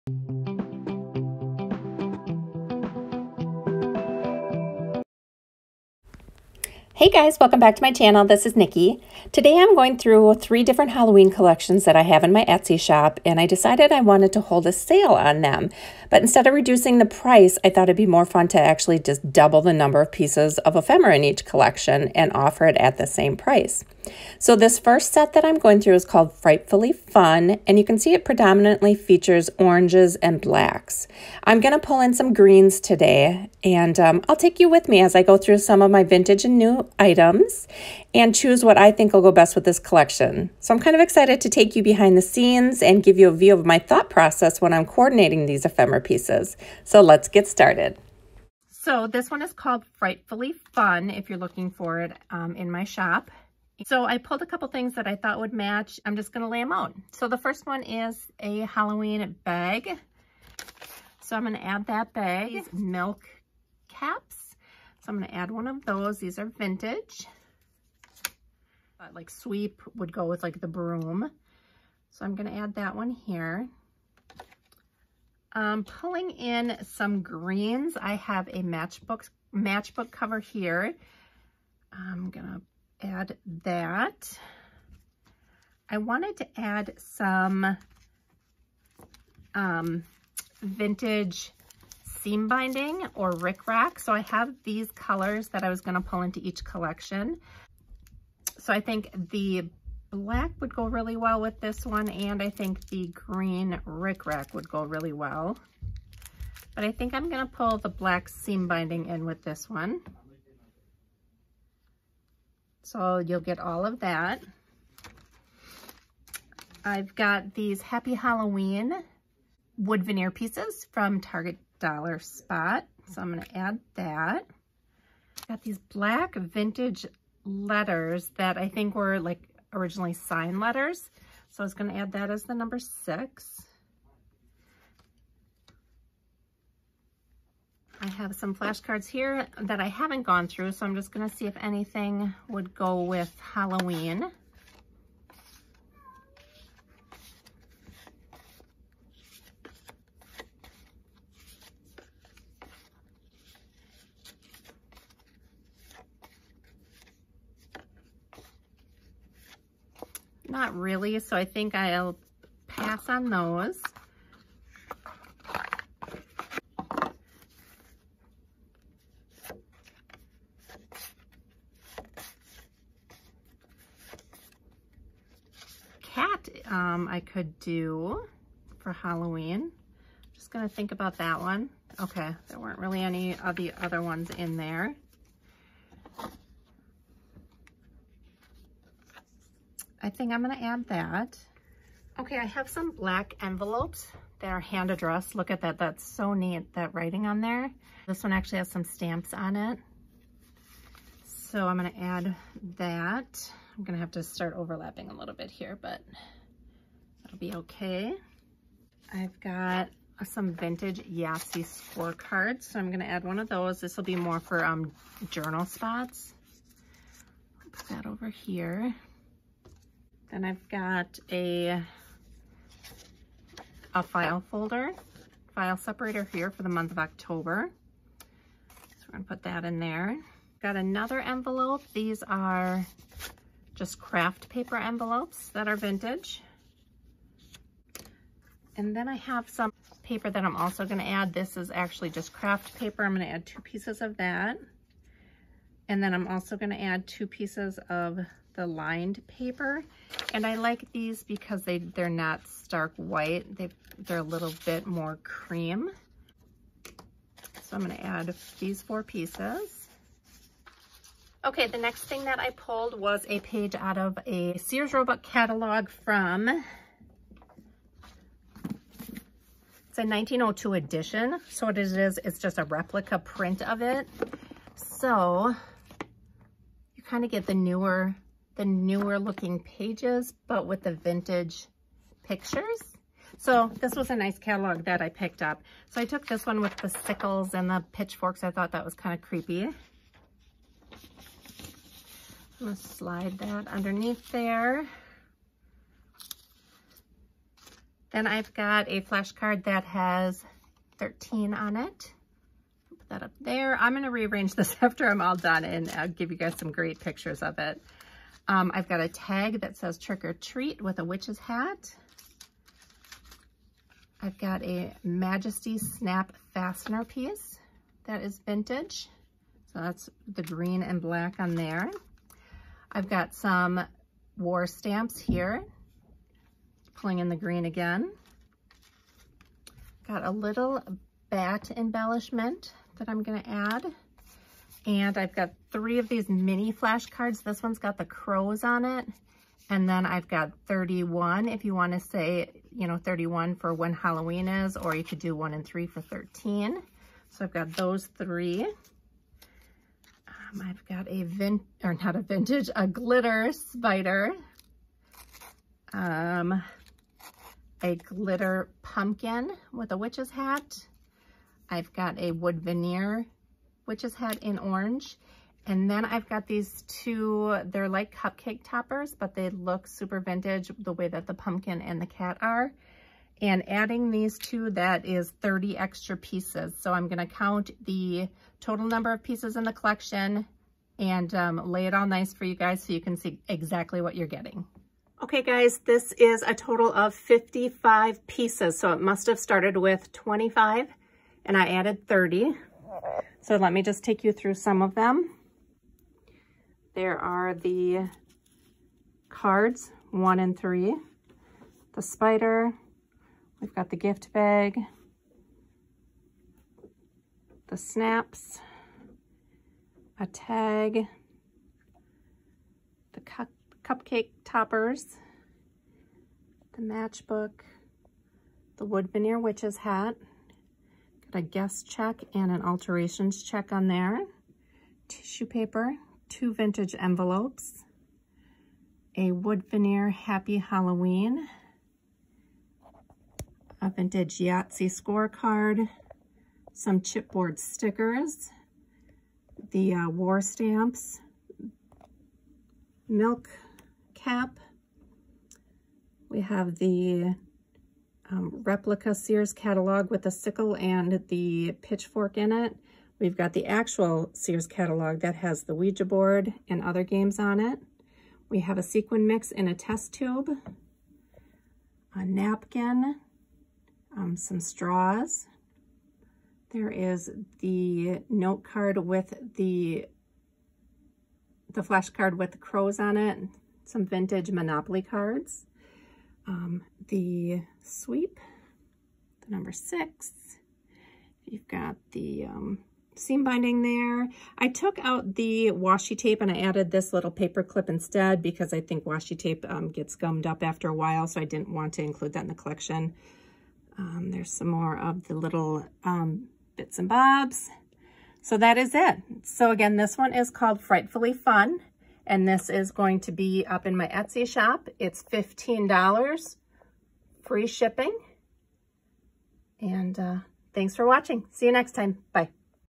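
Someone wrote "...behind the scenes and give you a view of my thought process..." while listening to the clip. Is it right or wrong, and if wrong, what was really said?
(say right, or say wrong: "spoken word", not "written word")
right.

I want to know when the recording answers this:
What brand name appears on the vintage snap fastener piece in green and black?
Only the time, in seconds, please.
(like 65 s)
315 s.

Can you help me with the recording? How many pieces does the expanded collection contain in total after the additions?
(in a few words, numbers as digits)
55.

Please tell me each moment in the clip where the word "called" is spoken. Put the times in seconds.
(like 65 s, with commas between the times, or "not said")
26 s, 49 s, 500 s.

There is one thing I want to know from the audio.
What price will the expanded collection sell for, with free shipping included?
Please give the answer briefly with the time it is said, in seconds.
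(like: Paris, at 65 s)
$15, at 505 s.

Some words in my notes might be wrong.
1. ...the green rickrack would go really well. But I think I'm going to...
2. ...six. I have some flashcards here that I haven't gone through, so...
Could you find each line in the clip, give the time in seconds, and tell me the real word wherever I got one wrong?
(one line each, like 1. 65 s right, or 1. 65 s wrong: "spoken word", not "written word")
1. 102 s right
2. 132 s right.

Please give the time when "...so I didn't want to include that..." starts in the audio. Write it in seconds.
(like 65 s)
491 s.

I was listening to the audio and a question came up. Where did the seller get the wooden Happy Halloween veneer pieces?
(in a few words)
Target Dollar Spot.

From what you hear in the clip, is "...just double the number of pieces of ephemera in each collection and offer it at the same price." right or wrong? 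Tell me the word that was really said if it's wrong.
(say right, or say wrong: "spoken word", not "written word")
right.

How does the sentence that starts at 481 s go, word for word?
You've got the um, seam binding there.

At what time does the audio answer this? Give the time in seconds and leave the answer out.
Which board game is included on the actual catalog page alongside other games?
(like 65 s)
455 s.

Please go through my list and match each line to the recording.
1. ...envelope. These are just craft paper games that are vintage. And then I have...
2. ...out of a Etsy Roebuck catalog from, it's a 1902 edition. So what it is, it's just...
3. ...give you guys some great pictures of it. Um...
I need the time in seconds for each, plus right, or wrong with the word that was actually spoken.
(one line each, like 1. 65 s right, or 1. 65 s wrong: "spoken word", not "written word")
1. 231 s wrong: "envelopes", not "games"
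2. 263 s wrong: "Sears", not "Etsy"
3. 306 s right.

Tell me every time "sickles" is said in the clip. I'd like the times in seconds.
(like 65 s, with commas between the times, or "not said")
286 s, 450 s.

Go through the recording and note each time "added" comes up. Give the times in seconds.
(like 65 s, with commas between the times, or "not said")
391 s, 486 s.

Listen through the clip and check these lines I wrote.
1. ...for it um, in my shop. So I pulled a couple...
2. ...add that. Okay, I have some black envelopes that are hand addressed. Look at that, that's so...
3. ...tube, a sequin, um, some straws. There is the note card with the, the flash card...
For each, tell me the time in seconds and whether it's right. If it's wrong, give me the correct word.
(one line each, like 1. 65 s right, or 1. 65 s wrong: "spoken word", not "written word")
1. 51 s right
2. 190 s right
3. 460 s wrong: "napkin", not "sequin".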